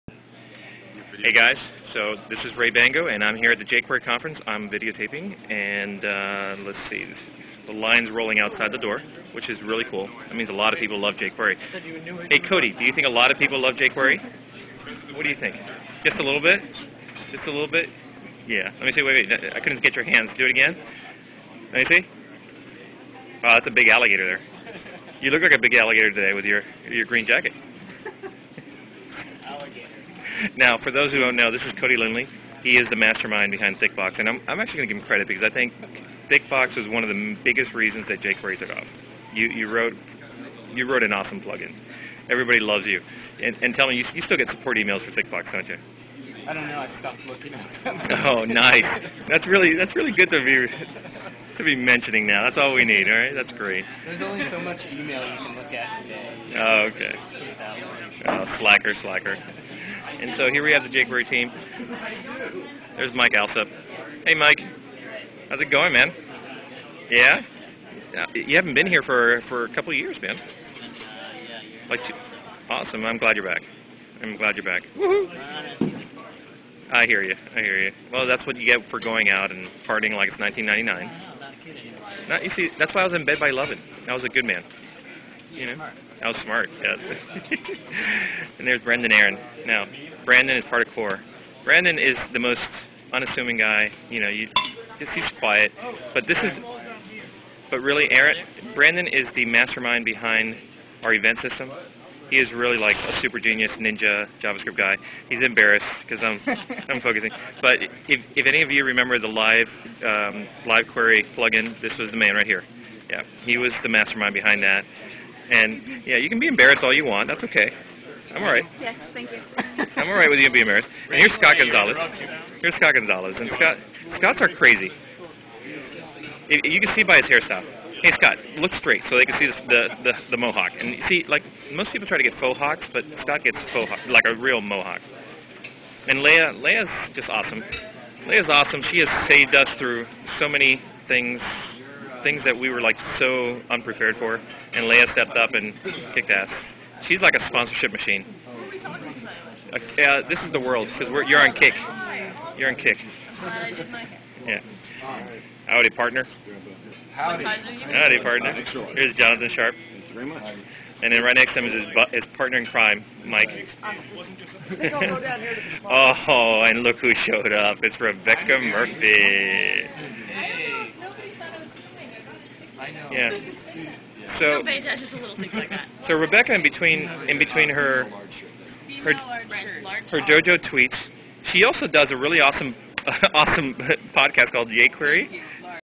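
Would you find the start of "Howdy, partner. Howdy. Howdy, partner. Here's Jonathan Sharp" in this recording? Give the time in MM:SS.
02:35.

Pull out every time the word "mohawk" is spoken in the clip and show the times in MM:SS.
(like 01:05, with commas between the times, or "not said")
02:10, 02:14.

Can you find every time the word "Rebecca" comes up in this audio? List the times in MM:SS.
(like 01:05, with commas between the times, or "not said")
02:47, 02:56.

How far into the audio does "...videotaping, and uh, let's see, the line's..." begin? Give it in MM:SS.
00:04.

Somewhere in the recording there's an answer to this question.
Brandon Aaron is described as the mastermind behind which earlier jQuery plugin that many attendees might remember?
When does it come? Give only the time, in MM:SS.
01:50.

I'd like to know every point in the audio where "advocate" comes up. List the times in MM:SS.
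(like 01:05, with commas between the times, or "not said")
not said.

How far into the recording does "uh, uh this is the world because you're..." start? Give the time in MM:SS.
02:28.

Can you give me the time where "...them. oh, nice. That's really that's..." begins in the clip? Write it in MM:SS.
00:47.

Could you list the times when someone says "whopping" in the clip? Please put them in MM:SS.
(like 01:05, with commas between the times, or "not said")
not said.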